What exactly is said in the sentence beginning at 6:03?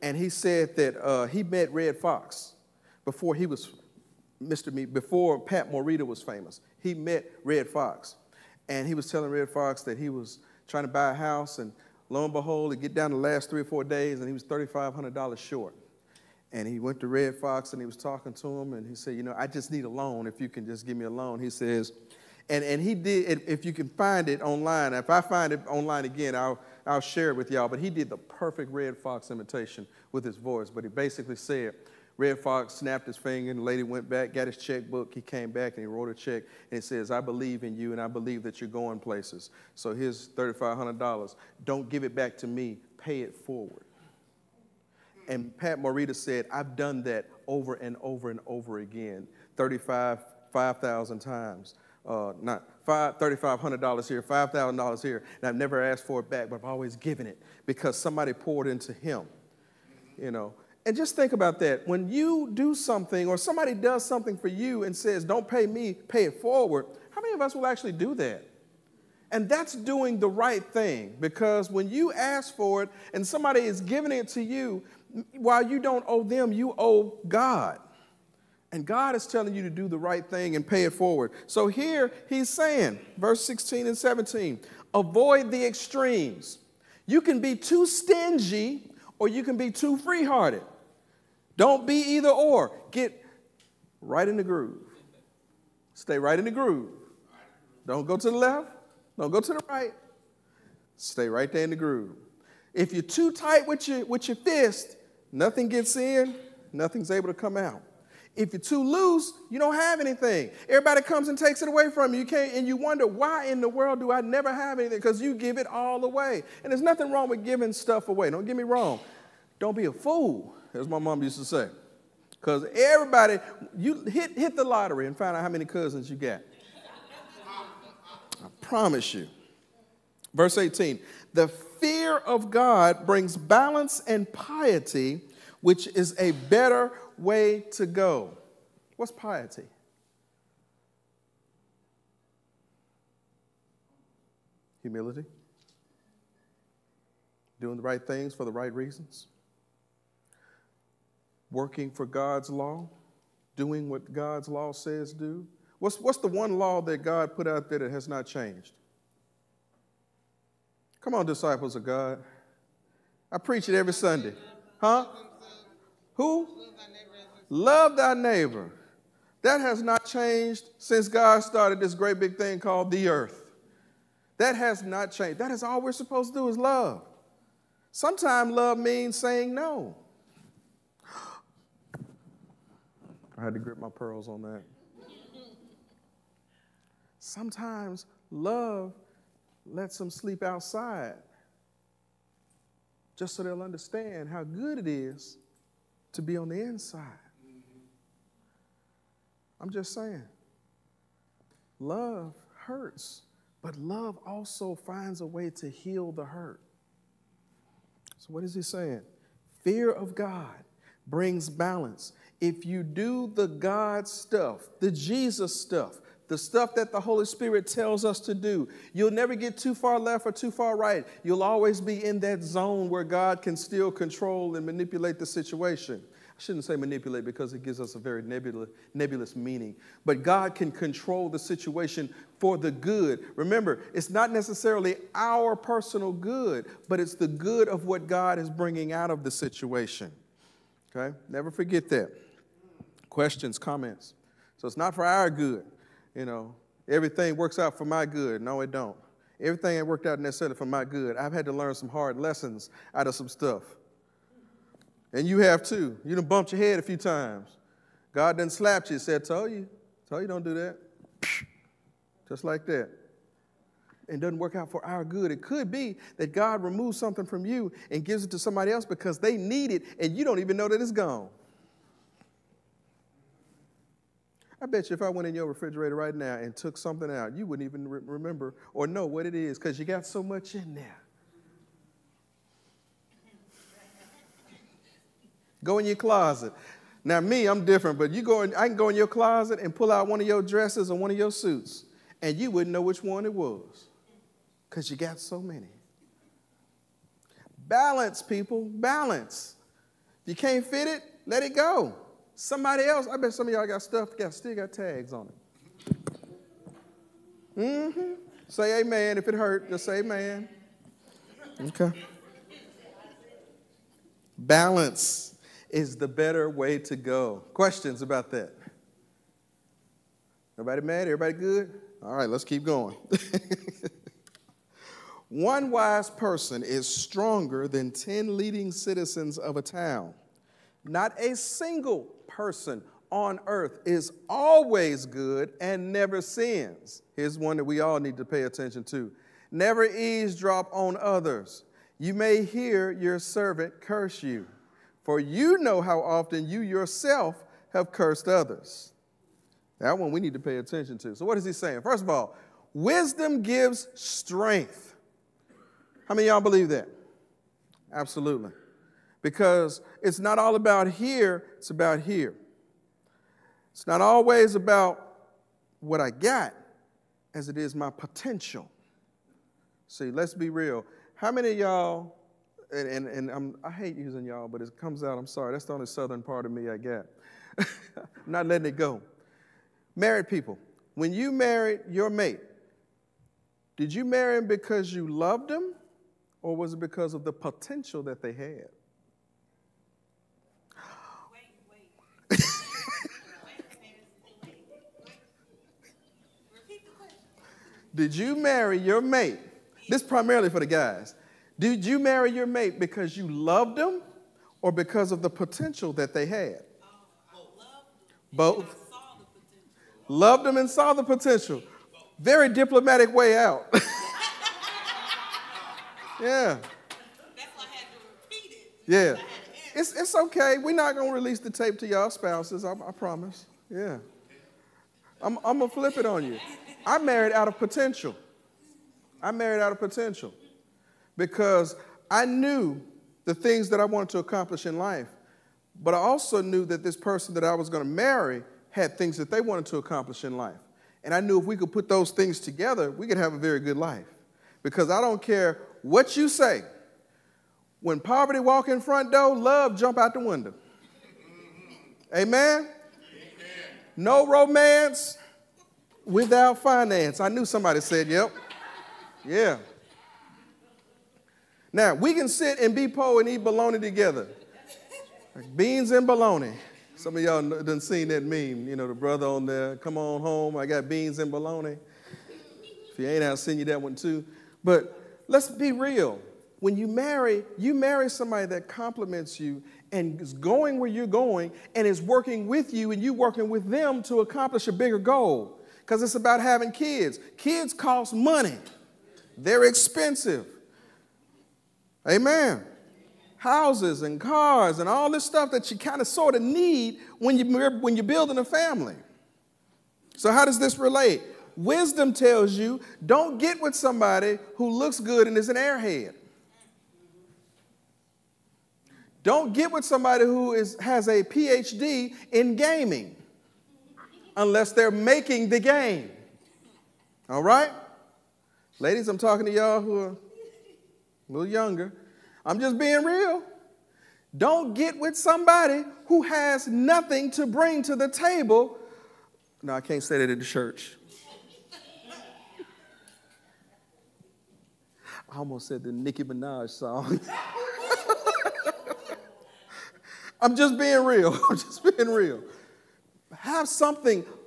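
It's not always about what I got as it is my potential.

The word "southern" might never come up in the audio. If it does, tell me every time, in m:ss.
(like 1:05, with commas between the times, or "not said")
6:15.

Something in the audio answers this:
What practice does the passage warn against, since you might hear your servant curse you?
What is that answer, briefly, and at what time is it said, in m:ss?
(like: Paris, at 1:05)
Eavesdrop, at 5:39.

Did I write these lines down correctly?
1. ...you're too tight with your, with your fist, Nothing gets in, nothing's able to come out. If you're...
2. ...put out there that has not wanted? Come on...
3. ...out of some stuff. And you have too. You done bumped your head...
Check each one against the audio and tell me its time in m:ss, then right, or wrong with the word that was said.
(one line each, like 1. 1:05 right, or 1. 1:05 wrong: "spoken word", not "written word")
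1. 1:42 right
2. 2:37 wrong: "changed", not "wanted"
3. 4:12 right.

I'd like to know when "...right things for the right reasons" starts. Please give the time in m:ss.
2:27.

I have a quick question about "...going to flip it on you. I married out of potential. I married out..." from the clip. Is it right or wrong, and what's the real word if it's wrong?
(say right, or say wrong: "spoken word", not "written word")
right.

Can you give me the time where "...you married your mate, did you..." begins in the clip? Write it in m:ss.
6:21.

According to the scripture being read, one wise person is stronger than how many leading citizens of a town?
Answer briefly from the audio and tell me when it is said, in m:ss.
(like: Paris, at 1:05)
10, at 5:27.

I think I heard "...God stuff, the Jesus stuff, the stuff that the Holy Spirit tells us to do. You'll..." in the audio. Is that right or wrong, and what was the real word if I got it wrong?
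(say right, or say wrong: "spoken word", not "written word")
right.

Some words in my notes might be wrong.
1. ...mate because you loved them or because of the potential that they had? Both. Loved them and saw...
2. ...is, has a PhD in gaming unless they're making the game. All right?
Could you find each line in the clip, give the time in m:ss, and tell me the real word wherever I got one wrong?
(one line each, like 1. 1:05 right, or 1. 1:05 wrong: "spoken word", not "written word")
1. 6:42 right
2. 8:30 right.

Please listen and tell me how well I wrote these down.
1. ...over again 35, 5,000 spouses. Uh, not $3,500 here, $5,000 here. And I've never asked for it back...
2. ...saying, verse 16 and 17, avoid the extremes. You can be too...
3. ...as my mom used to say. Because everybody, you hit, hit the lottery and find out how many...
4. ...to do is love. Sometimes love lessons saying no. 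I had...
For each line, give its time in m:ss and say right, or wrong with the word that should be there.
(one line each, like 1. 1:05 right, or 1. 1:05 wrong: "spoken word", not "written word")
1. 0:48 wrong: "times", not "spouses"
2. 1:22 right
3. 2:00 right
4. 2:56 wrong: "means", not "lessons".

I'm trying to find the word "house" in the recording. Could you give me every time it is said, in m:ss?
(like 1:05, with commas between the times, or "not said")
0:11, 8:13.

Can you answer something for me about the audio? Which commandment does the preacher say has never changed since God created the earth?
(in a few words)
Love thy neighbor.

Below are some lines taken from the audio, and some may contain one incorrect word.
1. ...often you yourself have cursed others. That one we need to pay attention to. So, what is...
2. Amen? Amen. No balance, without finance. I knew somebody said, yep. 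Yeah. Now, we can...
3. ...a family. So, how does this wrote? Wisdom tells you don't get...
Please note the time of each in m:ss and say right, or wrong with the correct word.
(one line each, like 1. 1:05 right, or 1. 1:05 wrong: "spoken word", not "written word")
1. 5:46 right
2. 7:32 wrong: "romance", not "balance"
3. 8:18 wrong: "relate", not "wrote".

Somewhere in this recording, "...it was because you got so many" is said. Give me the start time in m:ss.
4:53.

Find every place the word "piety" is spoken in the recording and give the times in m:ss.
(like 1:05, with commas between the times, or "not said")
2:14, 2:19.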